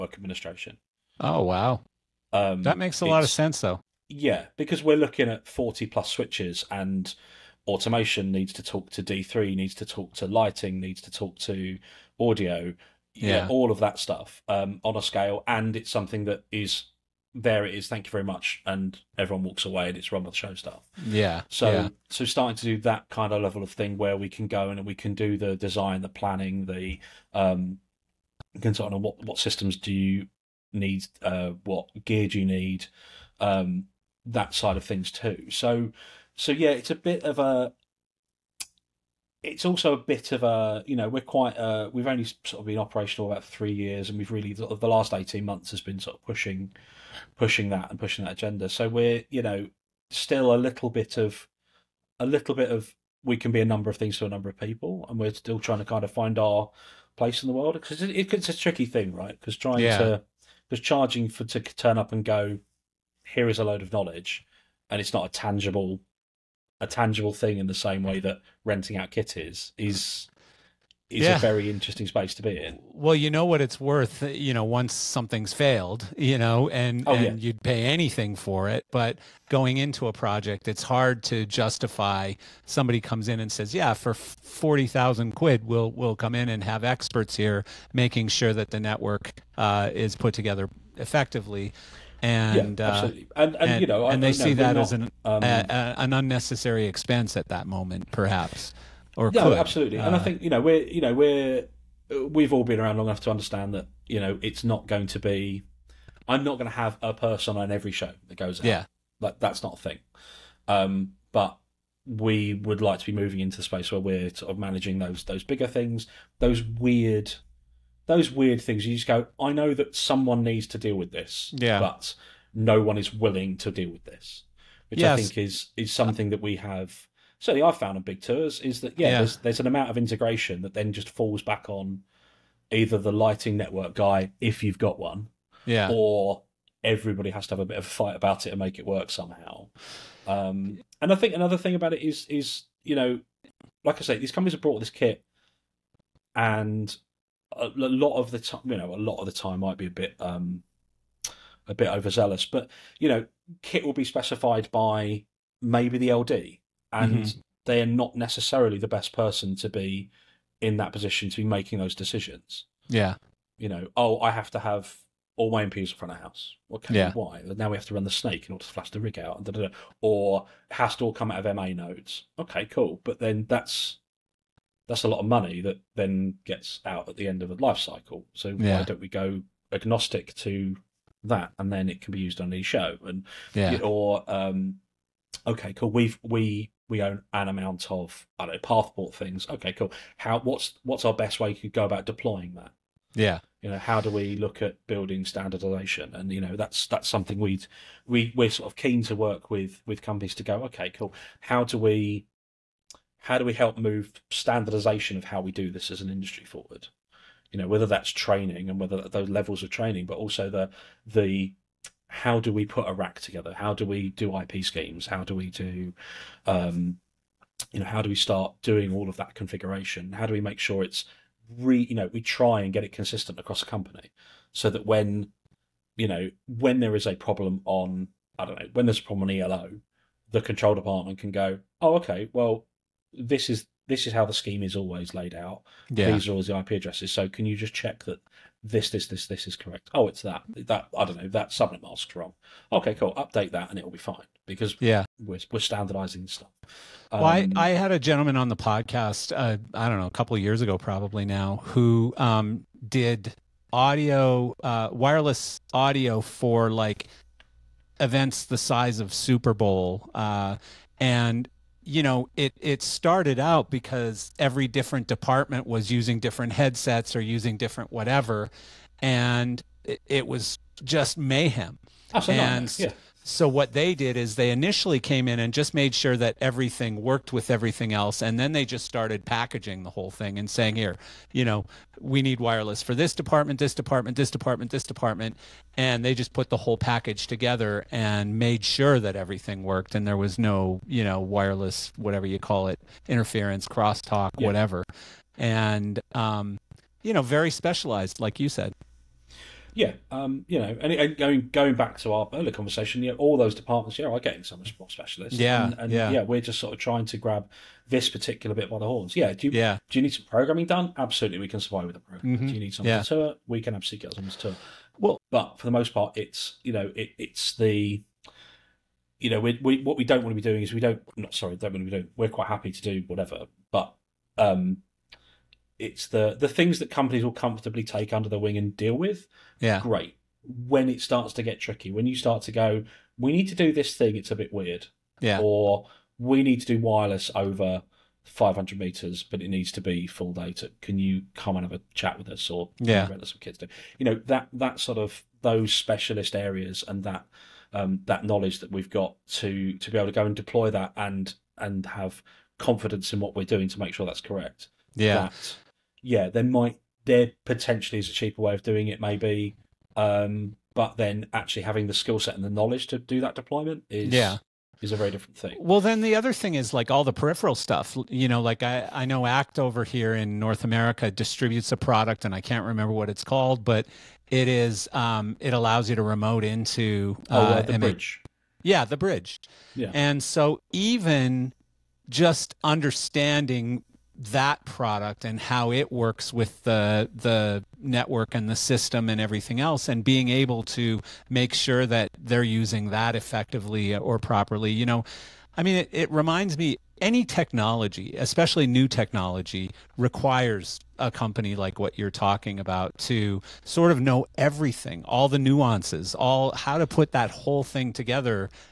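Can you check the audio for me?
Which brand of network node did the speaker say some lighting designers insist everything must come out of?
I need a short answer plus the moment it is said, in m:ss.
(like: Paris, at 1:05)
MA nodes, at 2:51.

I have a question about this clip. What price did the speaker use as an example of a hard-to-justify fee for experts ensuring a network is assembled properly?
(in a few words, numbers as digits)
40,000 quid.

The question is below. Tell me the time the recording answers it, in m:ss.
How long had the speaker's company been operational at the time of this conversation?
0:43.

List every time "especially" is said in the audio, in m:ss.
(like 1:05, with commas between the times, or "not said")
6:38.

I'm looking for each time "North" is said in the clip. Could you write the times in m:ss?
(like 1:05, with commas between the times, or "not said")
6:10.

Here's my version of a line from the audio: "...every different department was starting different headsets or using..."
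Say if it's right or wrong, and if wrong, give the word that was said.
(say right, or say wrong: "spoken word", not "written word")
wrong: "using", not "starting".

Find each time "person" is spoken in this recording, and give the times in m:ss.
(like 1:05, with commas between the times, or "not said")
1:47, 2:39.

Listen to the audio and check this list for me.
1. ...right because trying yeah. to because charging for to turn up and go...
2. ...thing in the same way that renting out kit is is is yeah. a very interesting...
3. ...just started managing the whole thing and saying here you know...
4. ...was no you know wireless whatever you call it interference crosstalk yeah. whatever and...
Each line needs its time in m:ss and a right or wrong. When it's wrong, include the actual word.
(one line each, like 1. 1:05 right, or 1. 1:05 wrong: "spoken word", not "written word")
1. 0:59 right
2. 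1:07 right
3. 4:38 wrong: "packaging", not "managing"
4. 4:50 right.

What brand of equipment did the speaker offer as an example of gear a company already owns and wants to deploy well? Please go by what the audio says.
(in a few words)
Pathport.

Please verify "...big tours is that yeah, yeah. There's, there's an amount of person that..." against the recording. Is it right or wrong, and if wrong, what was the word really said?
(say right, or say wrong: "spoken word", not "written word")
wrong: "integration", not "person".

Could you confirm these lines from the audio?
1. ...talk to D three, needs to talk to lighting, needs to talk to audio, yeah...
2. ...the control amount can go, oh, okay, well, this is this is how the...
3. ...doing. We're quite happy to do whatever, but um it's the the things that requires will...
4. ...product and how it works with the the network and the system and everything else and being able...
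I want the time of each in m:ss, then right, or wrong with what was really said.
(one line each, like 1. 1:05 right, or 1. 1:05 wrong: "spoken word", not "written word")
1. 0:08 right
2. 3:50 wrong: "department", not "amount"
3. 5:21 wrong: "companies", not "requires"
4. 6:24 right.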